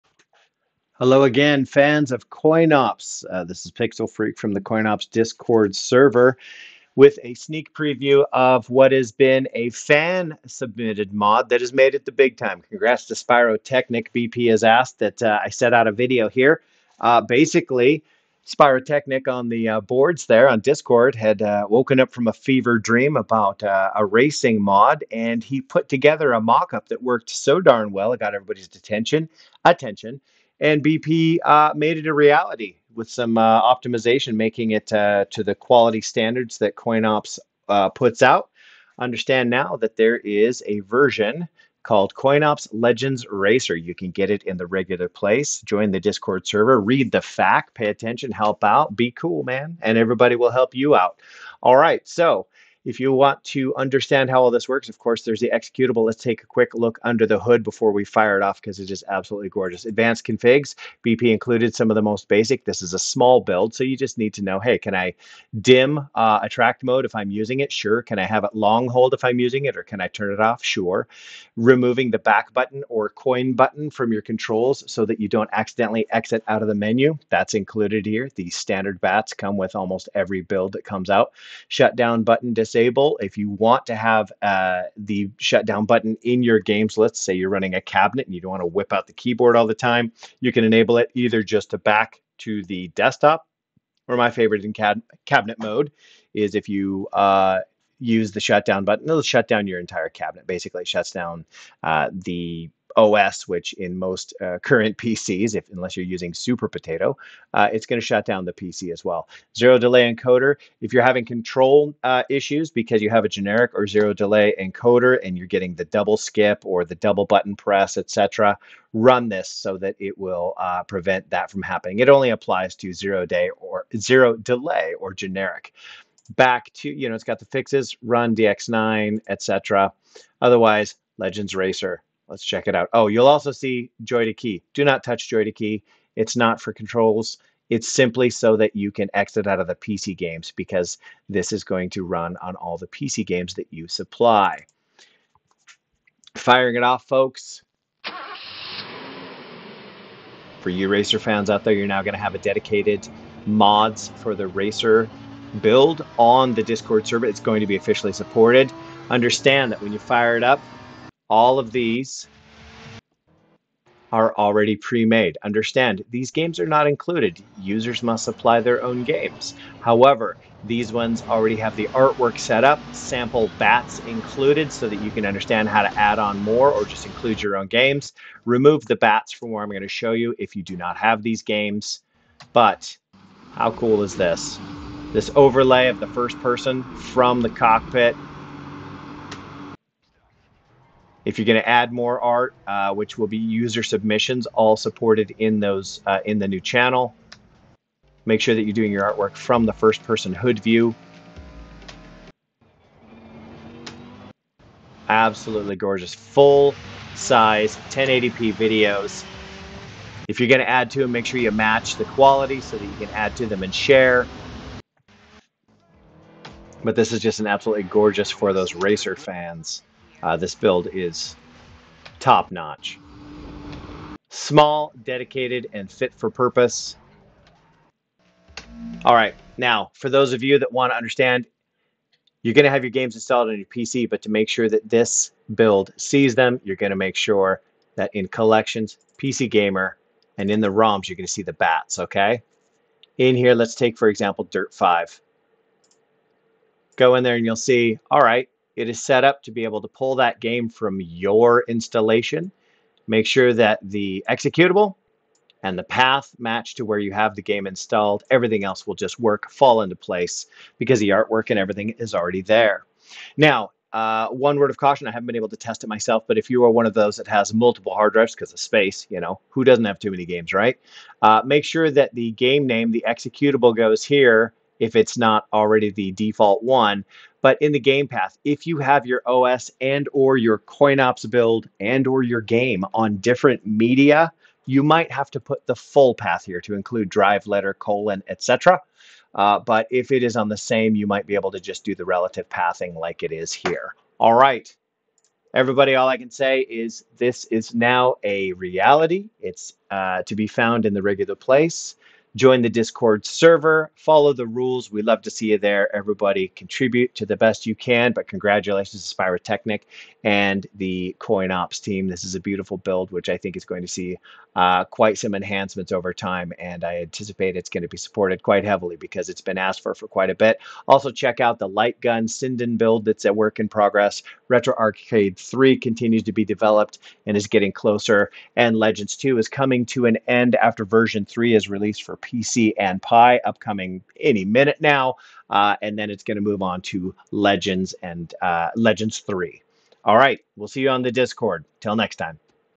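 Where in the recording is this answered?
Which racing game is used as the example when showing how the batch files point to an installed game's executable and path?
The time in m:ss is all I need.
4:04.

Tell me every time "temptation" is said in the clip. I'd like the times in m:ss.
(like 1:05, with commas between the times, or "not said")
not said.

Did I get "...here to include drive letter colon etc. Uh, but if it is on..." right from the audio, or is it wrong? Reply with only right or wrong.
right.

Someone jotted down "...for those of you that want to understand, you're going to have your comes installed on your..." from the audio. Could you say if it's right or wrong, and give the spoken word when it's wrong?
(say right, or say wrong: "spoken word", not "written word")
wrong: "games", not "comes".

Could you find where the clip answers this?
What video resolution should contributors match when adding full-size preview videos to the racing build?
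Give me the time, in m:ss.
3:27.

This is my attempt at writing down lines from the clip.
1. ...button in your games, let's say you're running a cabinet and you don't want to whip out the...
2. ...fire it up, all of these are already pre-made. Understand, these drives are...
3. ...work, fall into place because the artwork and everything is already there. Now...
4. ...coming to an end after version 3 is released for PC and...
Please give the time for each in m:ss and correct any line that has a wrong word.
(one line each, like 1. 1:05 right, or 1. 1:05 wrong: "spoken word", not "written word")
1. 1:25 right
2. 2:39 wrong: "games", not "drives"
3. 4:19 right
4. 5:29 right.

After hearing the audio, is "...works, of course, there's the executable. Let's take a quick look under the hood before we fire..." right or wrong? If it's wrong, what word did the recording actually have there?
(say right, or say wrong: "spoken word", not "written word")
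right.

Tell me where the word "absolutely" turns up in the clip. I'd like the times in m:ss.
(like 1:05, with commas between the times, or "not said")
0:59, 3:25, 3:37.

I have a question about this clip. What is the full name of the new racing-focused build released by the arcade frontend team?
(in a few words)
CoinOps Legends Racer.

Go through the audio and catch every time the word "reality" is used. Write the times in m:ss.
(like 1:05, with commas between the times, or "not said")
0:32, 4:58.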